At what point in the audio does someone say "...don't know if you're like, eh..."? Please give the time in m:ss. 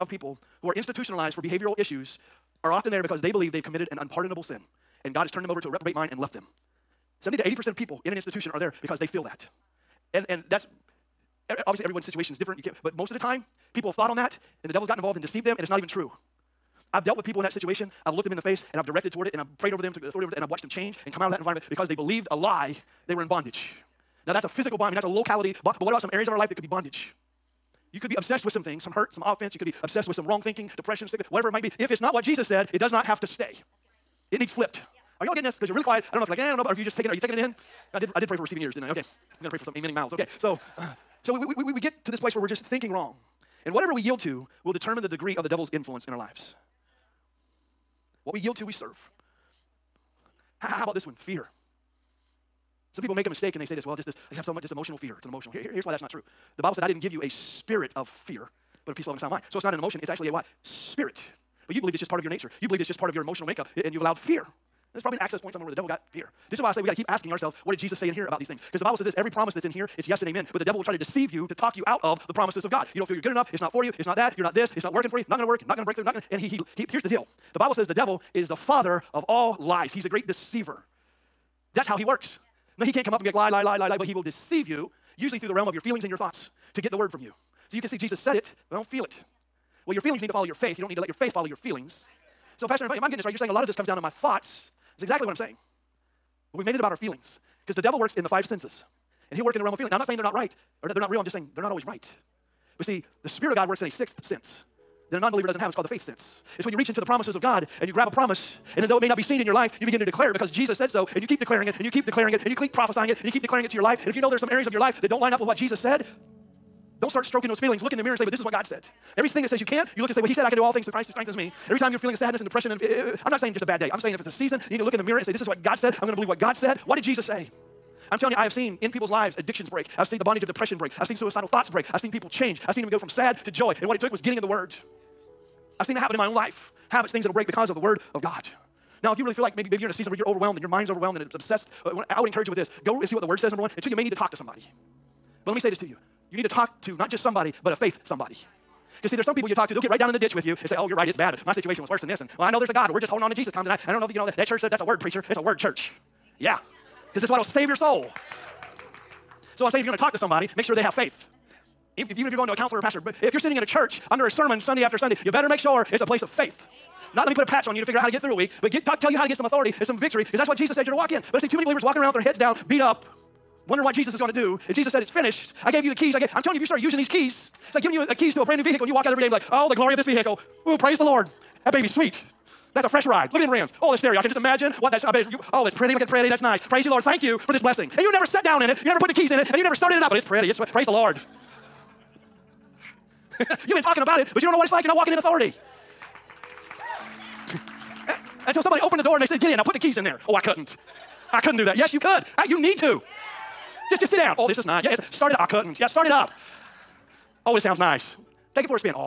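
0:36.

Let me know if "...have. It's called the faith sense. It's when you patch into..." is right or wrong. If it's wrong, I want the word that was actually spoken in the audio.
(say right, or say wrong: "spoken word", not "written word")
wrong: "reach", not "patch".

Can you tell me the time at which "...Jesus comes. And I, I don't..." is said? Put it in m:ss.
2:33.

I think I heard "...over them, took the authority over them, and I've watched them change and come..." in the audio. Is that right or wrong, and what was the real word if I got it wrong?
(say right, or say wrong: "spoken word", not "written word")
right.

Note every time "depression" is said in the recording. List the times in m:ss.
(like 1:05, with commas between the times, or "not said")
0:30, 2:02, 2:10.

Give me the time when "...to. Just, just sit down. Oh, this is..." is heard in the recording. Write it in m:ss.
3:22.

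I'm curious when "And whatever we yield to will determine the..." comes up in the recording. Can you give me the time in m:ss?
0:43.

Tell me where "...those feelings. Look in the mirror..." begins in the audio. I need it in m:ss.
1:57.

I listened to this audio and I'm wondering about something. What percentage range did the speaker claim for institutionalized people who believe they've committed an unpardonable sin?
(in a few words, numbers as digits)
70 to 80%.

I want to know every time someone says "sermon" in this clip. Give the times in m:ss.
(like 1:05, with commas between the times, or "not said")
2:44.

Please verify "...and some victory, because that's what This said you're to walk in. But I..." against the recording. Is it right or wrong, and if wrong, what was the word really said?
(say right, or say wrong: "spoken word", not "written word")
wrong: "Jesus", not "This".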